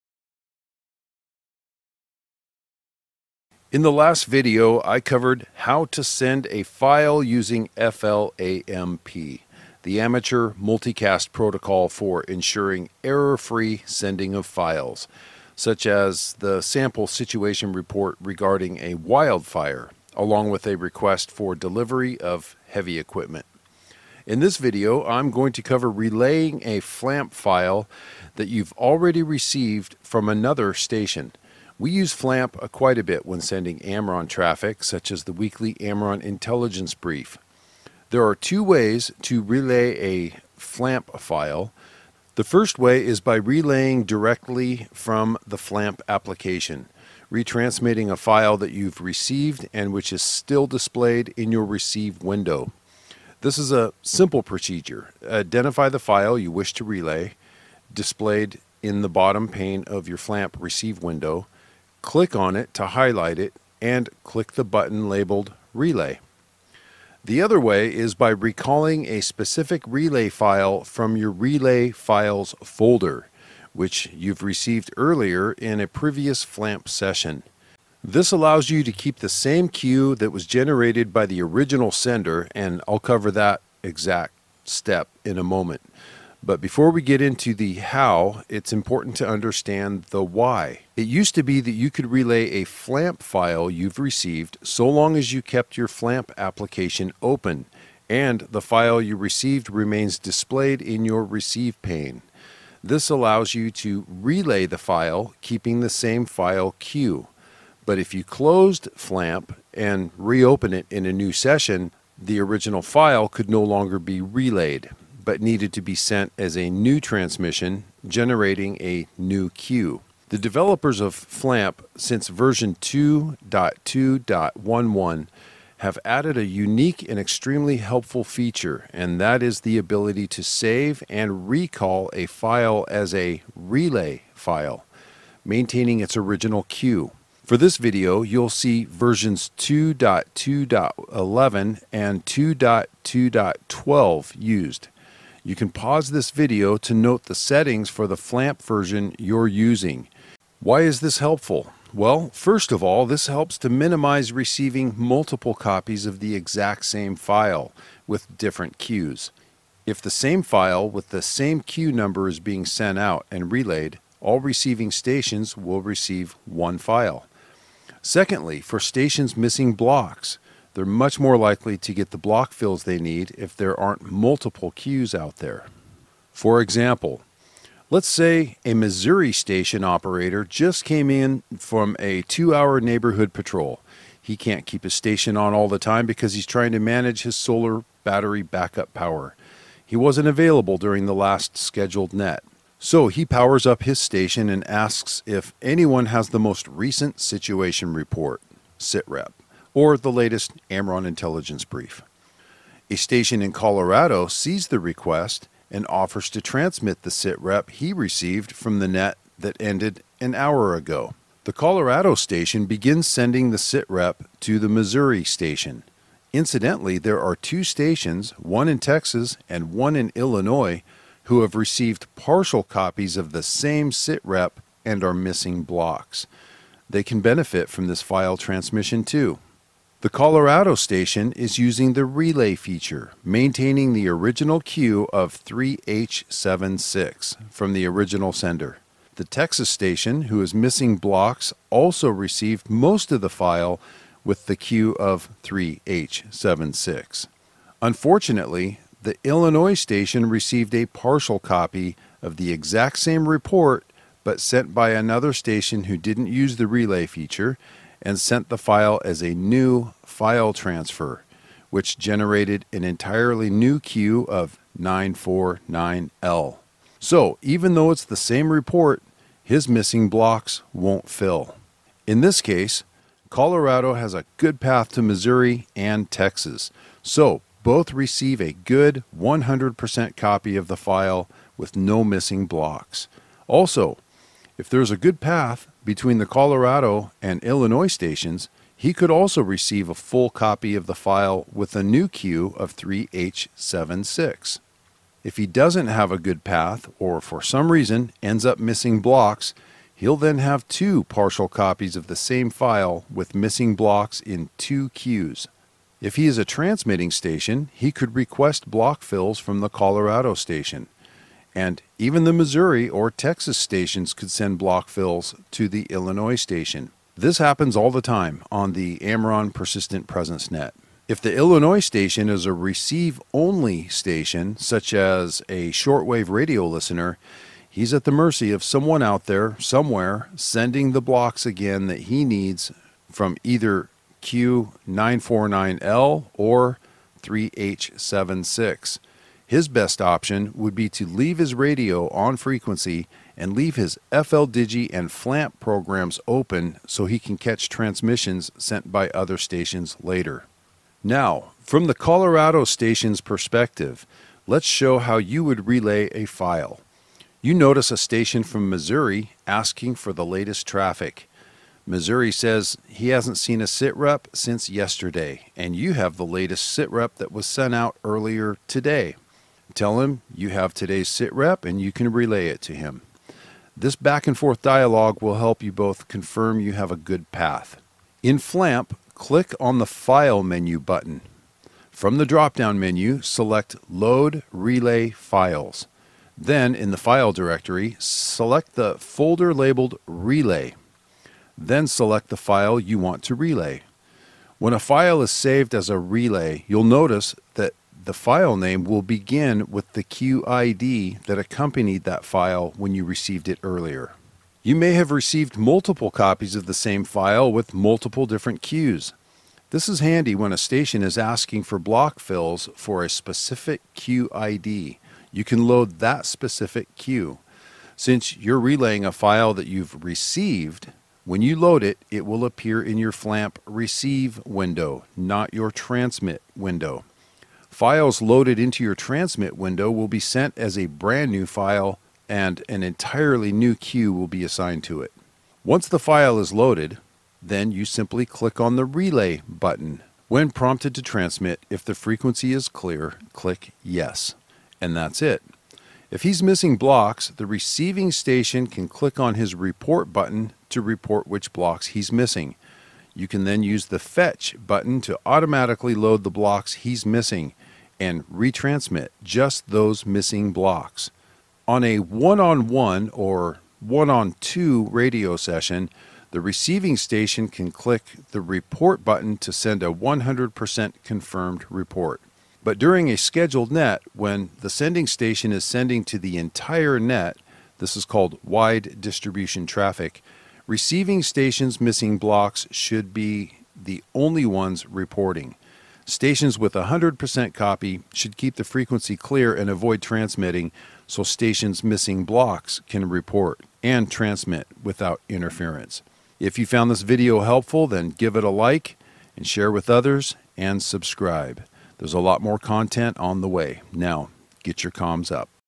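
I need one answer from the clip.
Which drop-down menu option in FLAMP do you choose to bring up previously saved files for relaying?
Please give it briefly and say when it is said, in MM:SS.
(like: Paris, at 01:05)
Load Relay Files, at 06:23.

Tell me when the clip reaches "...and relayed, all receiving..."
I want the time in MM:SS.
02:43.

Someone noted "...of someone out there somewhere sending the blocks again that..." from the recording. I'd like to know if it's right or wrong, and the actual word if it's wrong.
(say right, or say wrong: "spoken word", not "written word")
right.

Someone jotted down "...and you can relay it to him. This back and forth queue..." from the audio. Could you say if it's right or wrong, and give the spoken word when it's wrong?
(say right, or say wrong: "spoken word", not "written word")
wrong: "dialogue", not "queue".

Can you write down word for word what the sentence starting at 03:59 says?
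The Texas station, who is missing blocks, also received most of the file with the queue of 3H76.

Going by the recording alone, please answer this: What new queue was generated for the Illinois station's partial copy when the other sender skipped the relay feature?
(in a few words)
949L.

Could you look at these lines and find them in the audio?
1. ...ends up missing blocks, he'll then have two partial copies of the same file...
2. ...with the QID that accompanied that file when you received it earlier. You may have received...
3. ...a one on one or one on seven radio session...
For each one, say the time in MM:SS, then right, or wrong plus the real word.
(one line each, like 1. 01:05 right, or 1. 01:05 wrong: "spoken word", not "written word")
1. 04:58 right
2. 06:39 right
3. 07:41 wrong: "two", not "seven".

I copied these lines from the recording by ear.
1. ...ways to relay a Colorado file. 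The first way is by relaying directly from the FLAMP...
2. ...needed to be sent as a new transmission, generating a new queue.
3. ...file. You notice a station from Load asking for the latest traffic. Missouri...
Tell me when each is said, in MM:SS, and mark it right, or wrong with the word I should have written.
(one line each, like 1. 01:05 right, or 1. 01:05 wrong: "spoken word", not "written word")
1. 00:38 wrong: "FLAMP", not "Colorado"
2. 01:55 right
3. 05:56 wrong: "Missouri", not "Load".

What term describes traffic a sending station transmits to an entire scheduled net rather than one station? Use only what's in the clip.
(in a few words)
wide distribution traffic.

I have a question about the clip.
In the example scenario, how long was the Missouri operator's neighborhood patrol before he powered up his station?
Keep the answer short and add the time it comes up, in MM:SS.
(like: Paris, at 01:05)
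two hour, at 03:02.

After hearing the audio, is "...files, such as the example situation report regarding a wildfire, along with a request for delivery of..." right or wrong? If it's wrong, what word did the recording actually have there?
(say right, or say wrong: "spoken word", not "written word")
wrong: "sample", not "example".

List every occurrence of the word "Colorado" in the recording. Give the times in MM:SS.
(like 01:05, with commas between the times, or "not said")
03:23, 03:31, 03:50, 04:33, 04:46, 05:09, 05:51.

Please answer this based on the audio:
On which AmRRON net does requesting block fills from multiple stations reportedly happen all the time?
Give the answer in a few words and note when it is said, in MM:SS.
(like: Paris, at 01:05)
Persistent Presence Net, at 05:19.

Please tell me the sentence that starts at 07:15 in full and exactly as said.
Once the file is loaded, then you simply click on the relay button.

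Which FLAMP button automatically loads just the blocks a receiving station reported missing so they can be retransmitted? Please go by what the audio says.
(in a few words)
Fetch.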